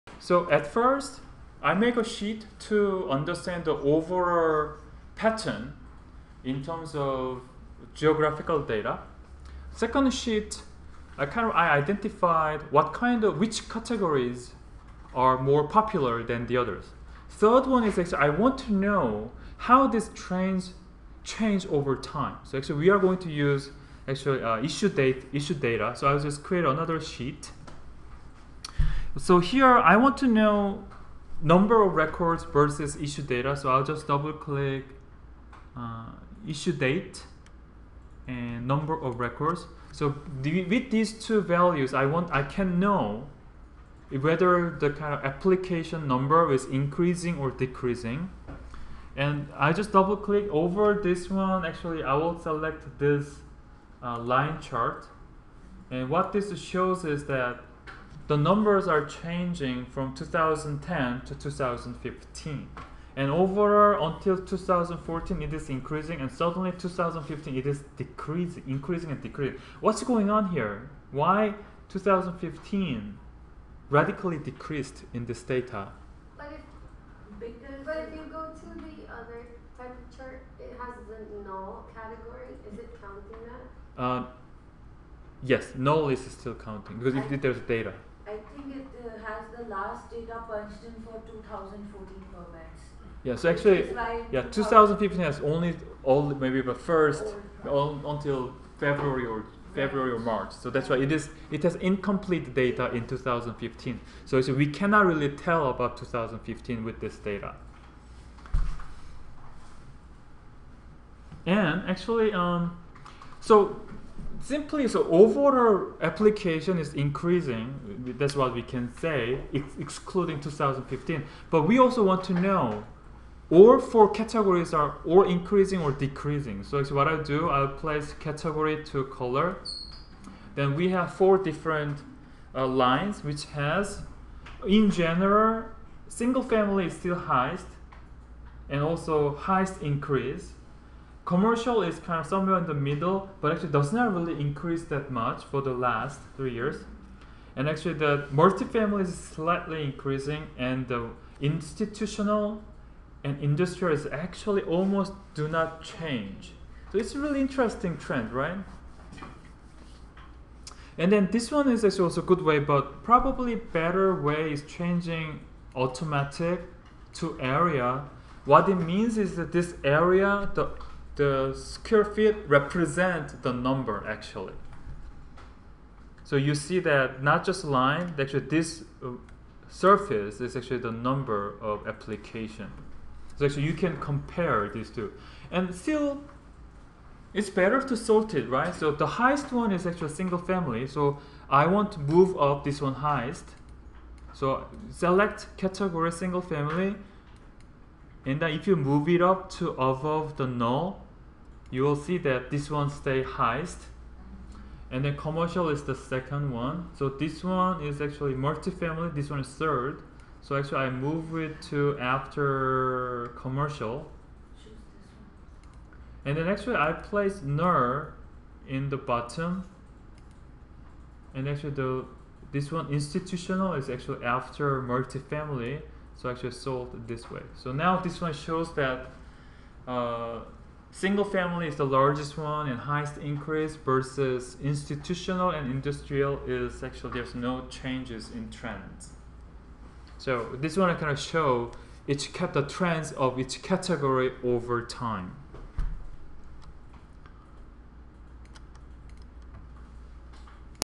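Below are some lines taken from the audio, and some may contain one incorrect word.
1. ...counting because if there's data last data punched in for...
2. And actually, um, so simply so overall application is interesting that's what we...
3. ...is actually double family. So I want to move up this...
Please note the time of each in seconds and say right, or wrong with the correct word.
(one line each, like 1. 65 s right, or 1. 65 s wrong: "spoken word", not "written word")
1. 86 s right
2. 111 s wrong: "increasing", not "interesting"
3. 189 s wrong: "single", not "double".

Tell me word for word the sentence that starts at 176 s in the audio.
So you see that not just line, actually this uh, surface is actually the number of application.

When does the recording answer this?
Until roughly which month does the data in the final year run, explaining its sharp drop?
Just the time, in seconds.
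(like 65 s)
99 s.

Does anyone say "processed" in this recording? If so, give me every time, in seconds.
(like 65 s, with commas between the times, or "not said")
not said.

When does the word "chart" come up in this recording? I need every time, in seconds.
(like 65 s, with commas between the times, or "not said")
54 s, 80 s.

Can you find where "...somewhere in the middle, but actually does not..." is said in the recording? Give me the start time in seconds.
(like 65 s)
142 s.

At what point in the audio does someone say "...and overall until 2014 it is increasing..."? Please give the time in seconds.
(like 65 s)
63 s.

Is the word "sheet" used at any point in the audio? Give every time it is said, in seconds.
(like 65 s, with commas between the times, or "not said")
2 s, 10 s, 27 s.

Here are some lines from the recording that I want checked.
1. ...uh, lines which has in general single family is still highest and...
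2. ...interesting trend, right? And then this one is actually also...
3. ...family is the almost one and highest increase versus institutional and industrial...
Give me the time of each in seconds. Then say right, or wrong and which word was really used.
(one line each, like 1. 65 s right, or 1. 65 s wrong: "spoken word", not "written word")
1. 132 s right
2. 157 s right
3. 231 s wrong: "largest", not "almost".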